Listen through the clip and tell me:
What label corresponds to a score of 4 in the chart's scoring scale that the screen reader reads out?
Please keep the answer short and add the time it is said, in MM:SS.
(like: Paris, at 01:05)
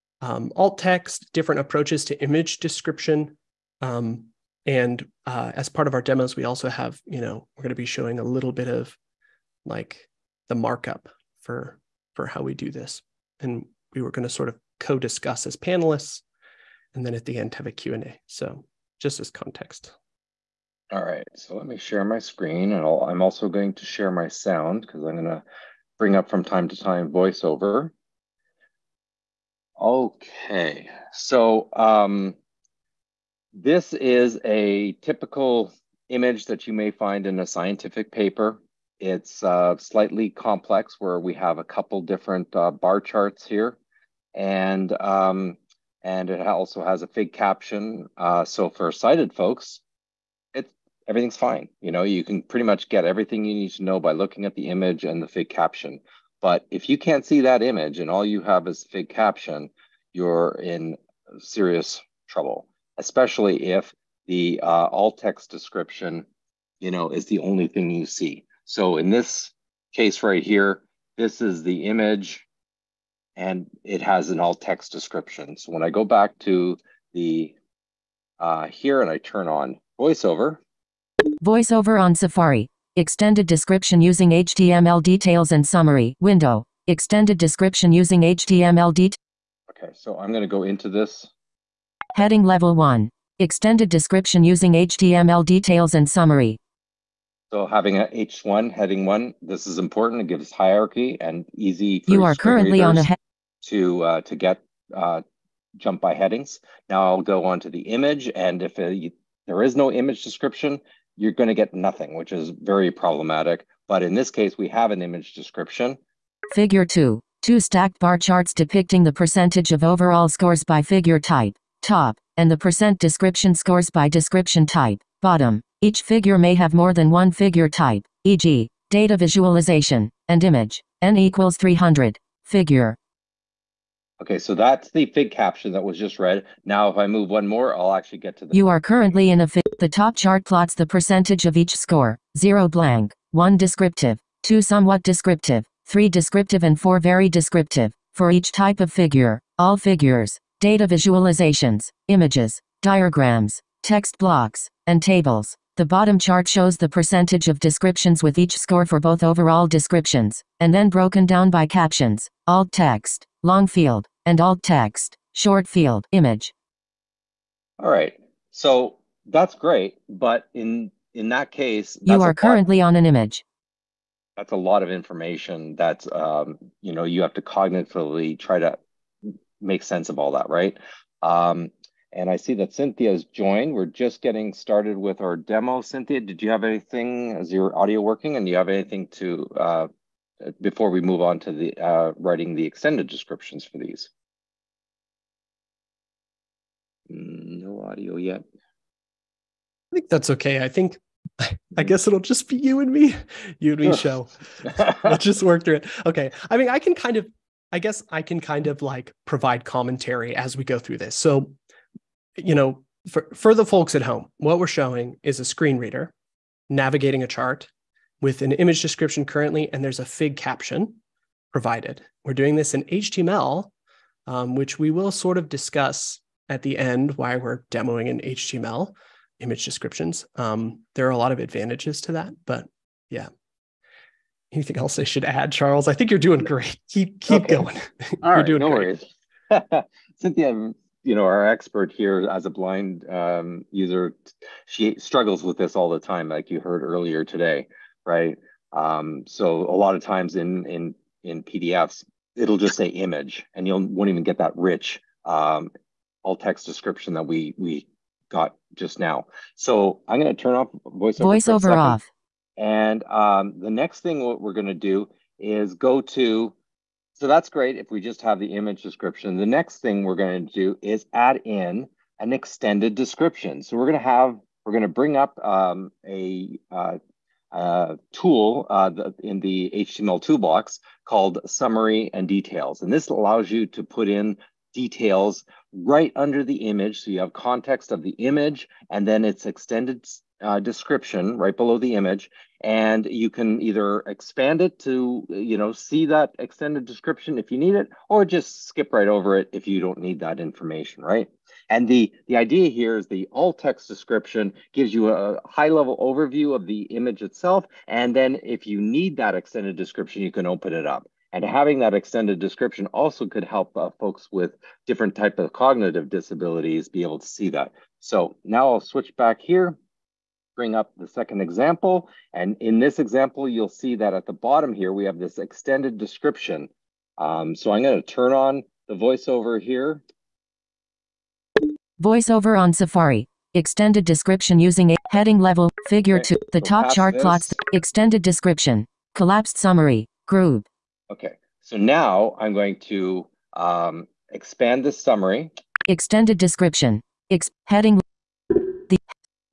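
very descriptive, at 02:26.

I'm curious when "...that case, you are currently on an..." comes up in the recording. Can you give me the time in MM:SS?
02:51.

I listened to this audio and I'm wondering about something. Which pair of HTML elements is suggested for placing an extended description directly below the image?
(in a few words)
summary and details.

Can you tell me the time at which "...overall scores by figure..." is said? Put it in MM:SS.
01:59.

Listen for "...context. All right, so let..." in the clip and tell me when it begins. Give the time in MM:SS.
00:19.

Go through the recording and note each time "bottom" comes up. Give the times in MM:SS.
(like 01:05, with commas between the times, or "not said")
02:05, 02:35, 05:24.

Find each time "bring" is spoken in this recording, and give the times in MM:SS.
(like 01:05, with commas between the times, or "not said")
00:25, 04:34, 05:20.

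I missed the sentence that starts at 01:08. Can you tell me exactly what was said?
So in this case right here, this is the image and it has an alt text description.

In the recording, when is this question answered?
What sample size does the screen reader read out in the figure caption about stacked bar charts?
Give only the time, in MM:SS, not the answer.
02:11.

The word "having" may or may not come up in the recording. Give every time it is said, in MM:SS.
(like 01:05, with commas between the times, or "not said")
01:37, 05:11.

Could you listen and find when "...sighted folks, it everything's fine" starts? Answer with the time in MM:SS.
00:48.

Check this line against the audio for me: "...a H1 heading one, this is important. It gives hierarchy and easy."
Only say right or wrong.
right.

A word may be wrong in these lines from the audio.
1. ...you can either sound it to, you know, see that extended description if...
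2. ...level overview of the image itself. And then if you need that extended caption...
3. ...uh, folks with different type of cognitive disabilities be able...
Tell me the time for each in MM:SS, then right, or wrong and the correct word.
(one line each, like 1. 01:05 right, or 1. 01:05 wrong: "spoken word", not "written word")
1. 04:53 wrong: "expand", not "sound"
2. 05:05 wrong: "description", not "caption"
3. 05:13 right.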